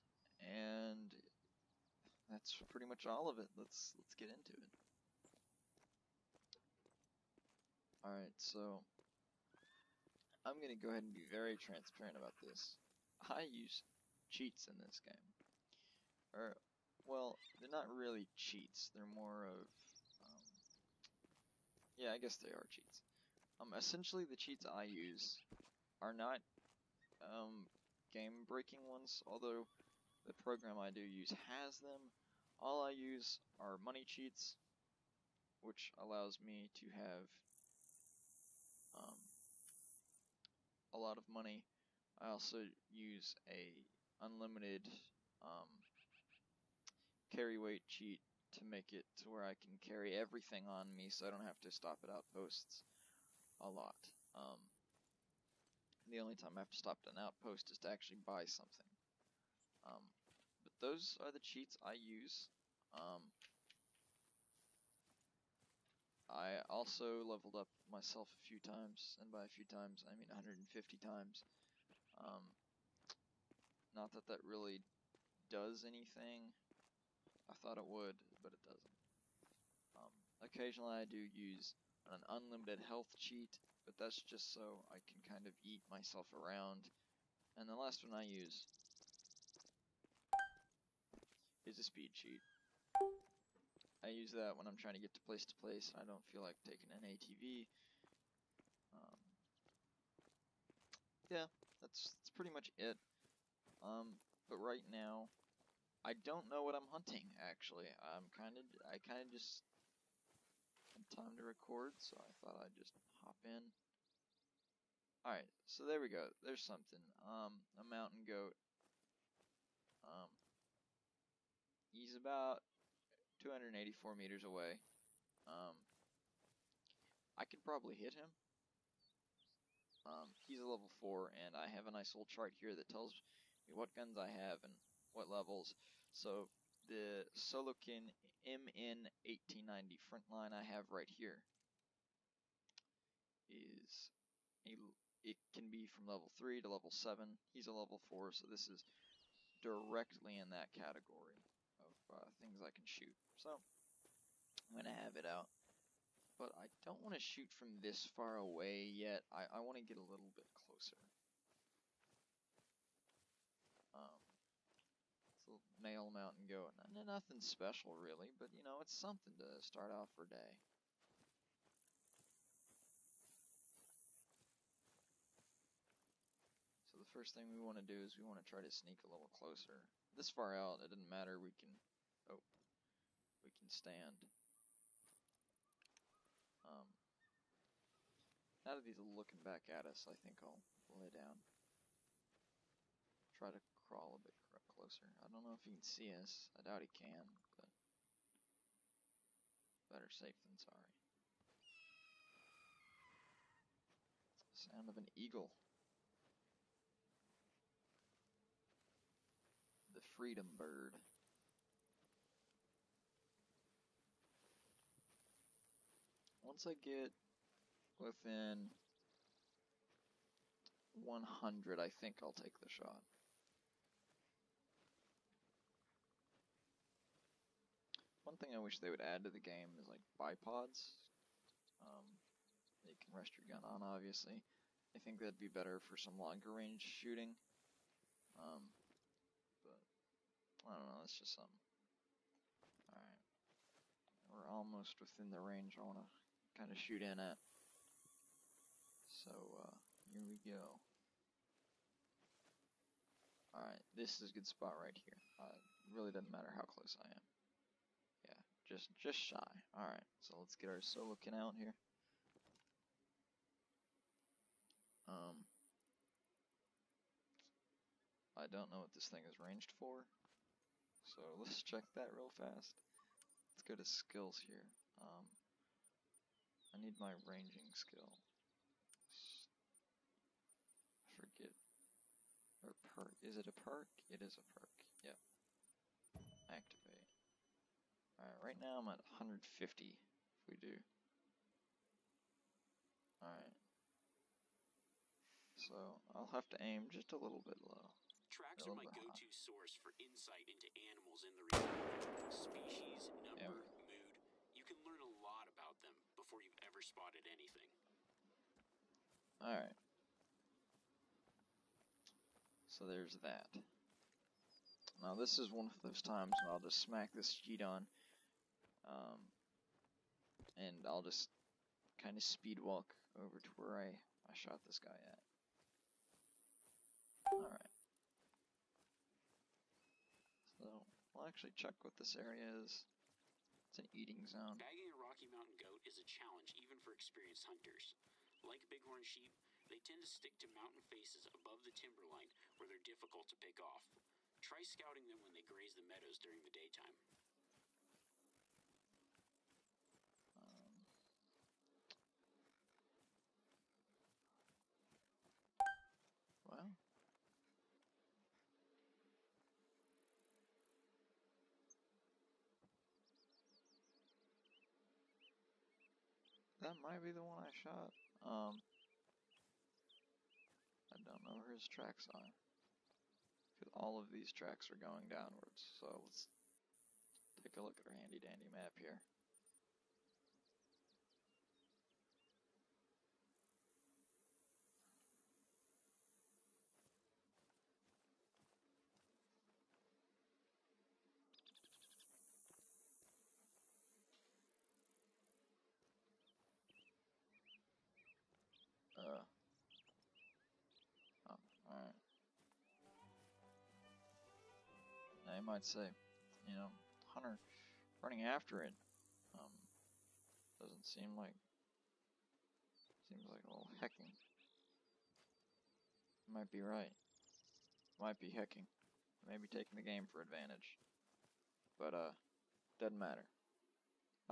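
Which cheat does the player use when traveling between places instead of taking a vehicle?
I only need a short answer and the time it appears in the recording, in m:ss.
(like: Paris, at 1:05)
speed cheat, at 1:31.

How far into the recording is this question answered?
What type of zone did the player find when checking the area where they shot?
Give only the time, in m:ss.
5:33.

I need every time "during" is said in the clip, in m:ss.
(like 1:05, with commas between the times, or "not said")
5:46.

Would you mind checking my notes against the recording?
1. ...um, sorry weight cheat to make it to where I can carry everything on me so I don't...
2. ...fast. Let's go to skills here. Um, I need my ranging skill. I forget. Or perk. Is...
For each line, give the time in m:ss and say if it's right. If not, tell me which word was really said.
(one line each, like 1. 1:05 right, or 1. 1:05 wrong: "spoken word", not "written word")
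1. 0:45 wrong: "carry", not "sorry"
2. 4:32 right.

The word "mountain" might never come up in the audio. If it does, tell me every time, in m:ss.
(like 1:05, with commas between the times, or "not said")
1:57, 2:46, 5:35, 5:40.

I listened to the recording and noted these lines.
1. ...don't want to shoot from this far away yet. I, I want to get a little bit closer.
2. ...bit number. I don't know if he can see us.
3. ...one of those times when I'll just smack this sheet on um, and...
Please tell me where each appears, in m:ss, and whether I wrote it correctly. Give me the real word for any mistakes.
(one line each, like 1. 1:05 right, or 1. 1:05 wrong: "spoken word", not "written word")
1. 2:36 right
2. 3:14 wrong: "closer", not "number"
3. 5:15 right.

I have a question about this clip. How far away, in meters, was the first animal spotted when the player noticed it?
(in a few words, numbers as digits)
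284.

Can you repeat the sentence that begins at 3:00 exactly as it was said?
This far out, it doesn't matter, we can, oh, we can stand.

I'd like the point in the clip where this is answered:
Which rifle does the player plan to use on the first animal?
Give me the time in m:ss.
2:17.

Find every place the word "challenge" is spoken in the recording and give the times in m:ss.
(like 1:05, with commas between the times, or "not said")
5:36.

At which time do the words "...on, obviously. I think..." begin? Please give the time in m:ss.
3:53.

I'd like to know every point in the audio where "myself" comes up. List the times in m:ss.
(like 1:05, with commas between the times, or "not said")
1:07, 1:25.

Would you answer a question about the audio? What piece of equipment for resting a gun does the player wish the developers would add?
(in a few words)
bipods.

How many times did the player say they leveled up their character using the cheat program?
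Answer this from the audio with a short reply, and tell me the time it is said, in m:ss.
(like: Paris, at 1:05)
150, at 1:10.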